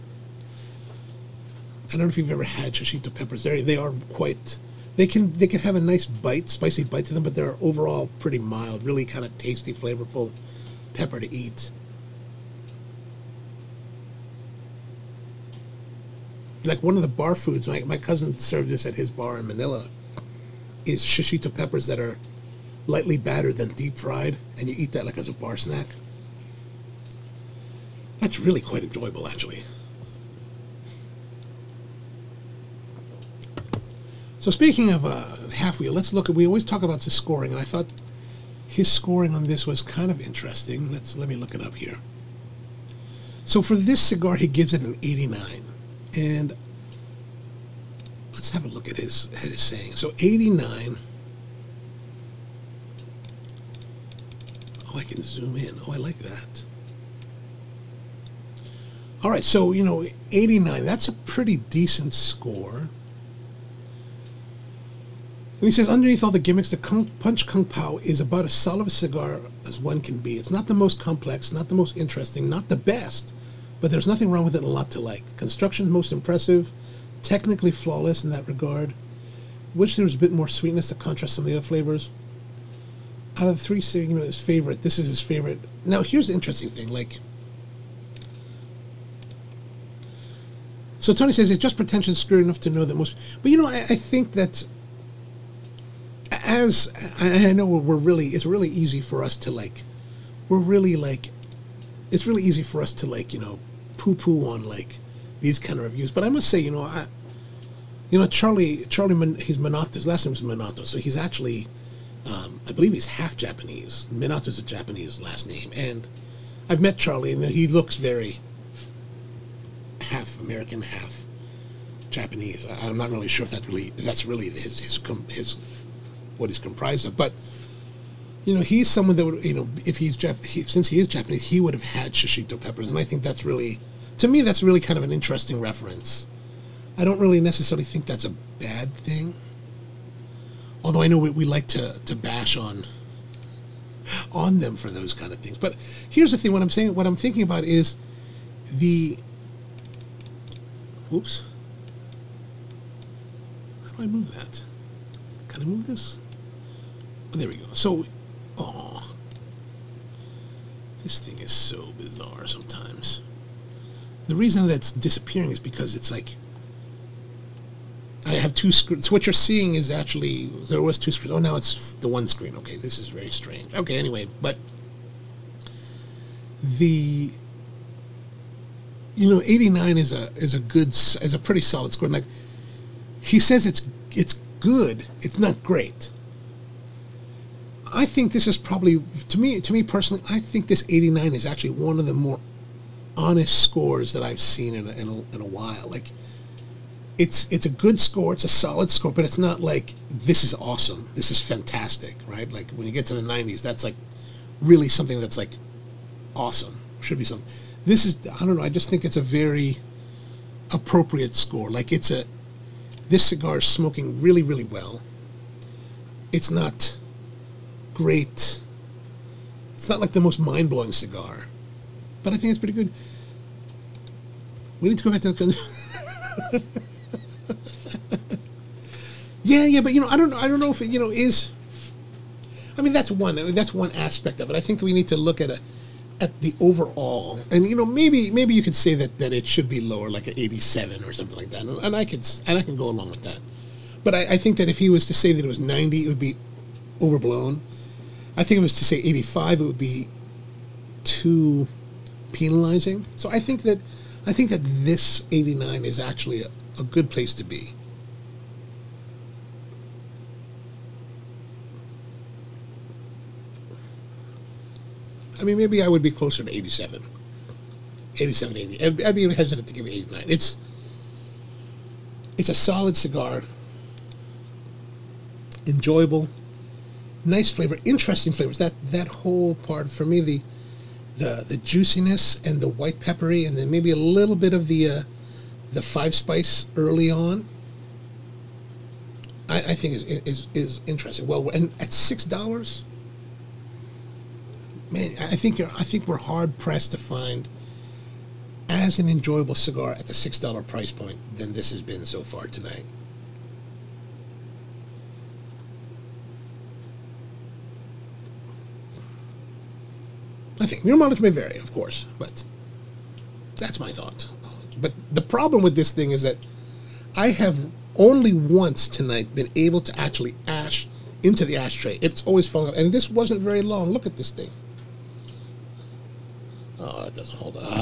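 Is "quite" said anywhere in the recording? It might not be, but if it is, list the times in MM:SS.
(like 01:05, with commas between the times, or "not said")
00:04, 00:28.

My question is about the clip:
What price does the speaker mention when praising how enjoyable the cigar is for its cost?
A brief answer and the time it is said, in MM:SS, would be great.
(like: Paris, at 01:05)
$6, at 04:51.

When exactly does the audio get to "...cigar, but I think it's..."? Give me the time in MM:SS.
03:40.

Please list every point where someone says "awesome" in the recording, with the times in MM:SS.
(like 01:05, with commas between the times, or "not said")
03:20, 03:26.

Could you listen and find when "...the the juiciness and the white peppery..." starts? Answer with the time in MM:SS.
04:41.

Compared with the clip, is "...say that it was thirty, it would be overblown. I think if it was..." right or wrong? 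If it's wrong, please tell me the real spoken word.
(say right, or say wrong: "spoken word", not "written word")
wrong: "ninety", not "thirty".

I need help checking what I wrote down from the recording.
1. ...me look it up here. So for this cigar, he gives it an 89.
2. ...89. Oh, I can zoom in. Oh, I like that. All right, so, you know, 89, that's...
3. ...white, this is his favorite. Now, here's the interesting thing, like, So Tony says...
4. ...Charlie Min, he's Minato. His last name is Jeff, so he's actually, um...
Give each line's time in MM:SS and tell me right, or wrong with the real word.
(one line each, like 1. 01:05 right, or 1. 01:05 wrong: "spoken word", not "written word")
1. 00:41 right
2. 00:50 right
3. 01:24 wrong: "favorite", not "white"
4. 01:48 wrong: "Minato", not "Jeff".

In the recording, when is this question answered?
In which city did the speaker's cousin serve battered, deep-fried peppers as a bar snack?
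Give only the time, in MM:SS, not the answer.
00:19.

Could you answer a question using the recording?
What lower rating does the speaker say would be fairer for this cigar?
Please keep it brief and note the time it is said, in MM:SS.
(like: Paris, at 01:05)
87, at 04:00.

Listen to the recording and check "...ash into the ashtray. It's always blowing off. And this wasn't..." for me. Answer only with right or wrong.
wrong.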